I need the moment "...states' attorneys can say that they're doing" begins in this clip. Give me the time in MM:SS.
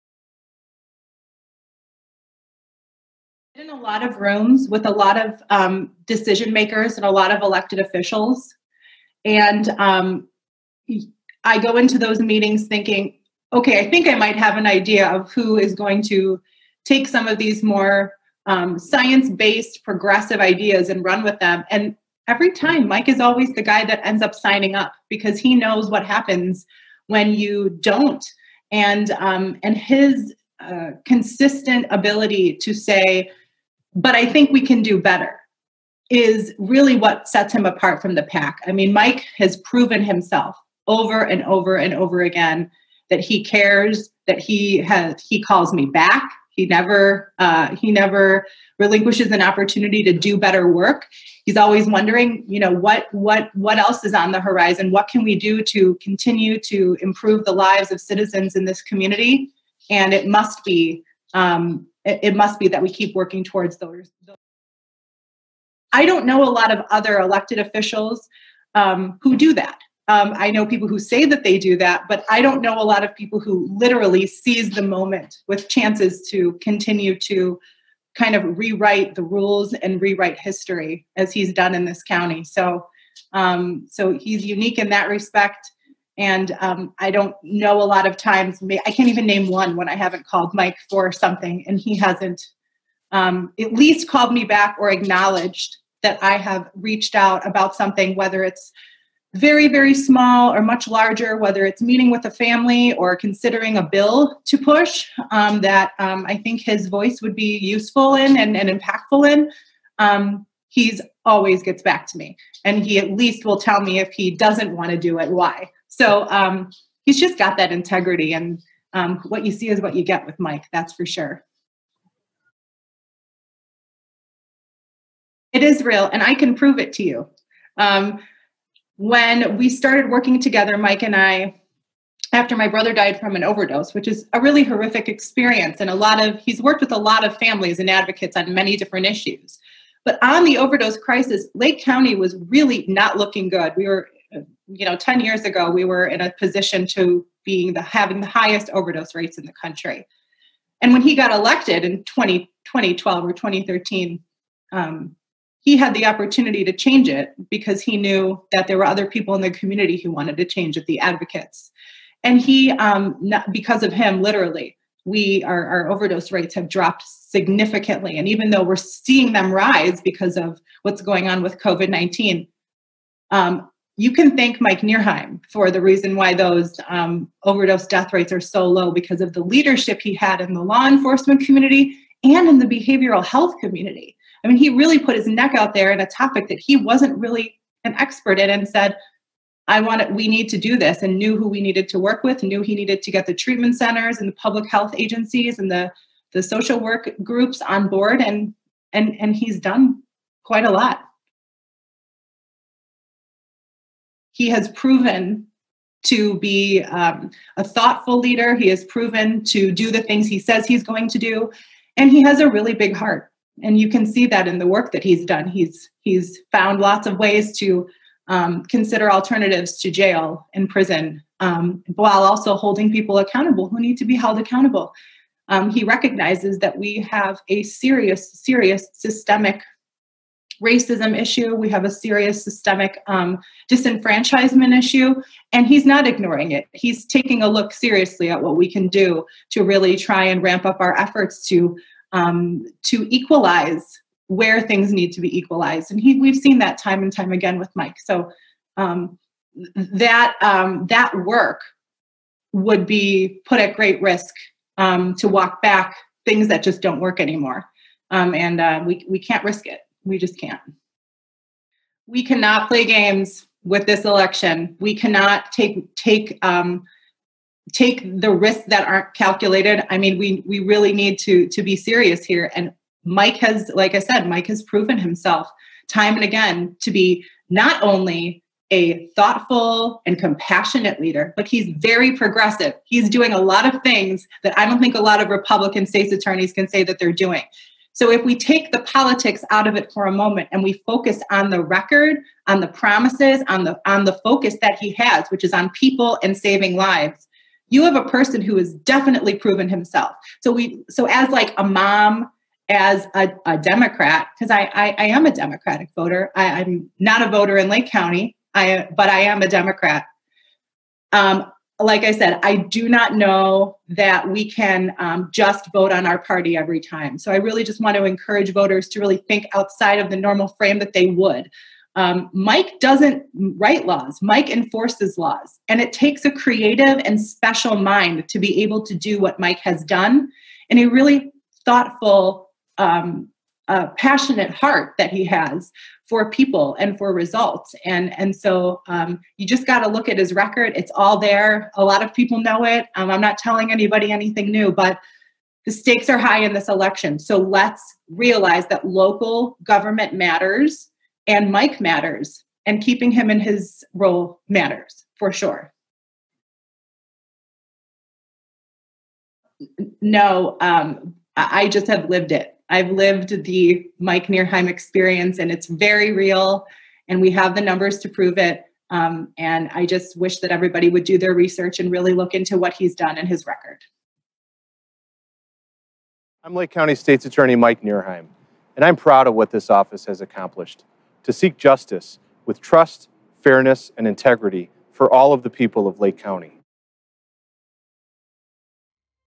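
04:45.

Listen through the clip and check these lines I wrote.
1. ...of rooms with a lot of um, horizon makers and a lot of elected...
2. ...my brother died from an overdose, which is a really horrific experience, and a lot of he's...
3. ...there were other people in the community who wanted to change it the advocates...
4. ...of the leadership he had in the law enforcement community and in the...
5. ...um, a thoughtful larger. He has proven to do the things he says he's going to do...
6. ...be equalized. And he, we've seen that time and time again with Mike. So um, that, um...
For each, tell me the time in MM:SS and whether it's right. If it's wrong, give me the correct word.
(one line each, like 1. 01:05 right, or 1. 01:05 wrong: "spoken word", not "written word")
1. 00:04 wrong: "decision", not "horizon"
2. 02:12 right
3. 02:38 right
4. 02:59 right
5. 03:26 wrong: "leader", not "larger"
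6. 04:05 right.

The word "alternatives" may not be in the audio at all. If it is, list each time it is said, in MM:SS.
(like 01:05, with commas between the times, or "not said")
03:39.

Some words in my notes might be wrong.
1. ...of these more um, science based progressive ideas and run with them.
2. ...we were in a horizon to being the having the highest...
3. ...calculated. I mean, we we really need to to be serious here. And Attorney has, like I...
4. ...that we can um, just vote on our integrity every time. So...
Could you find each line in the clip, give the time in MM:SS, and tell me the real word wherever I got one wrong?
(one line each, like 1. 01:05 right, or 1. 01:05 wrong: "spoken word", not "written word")
1. 00:17 right
2. 02:25 wrong: "position", not "horizon"
3. 04:29 wrong: "Mike", not "Attorney"
4. 05:13 wrong: "party", not "integrity".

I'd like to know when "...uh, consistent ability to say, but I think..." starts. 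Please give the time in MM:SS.
00:30.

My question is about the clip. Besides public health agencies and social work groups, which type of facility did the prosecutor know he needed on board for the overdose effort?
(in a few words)
Treatment centers.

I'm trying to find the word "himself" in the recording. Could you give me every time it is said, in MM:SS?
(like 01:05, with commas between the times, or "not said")
00:40, 04:34, 04:59.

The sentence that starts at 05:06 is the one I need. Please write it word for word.
I, am not a voter in Lake County, I but I am a Democrat.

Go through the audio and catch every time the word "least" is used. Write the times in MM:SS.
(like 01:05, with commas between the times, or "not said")
01:33, 01:53.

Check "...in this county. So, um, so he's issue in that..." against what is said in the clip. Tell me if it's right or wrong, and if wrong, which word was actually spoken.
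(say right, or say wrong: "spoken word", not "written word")
wrong: "unique", not "issue".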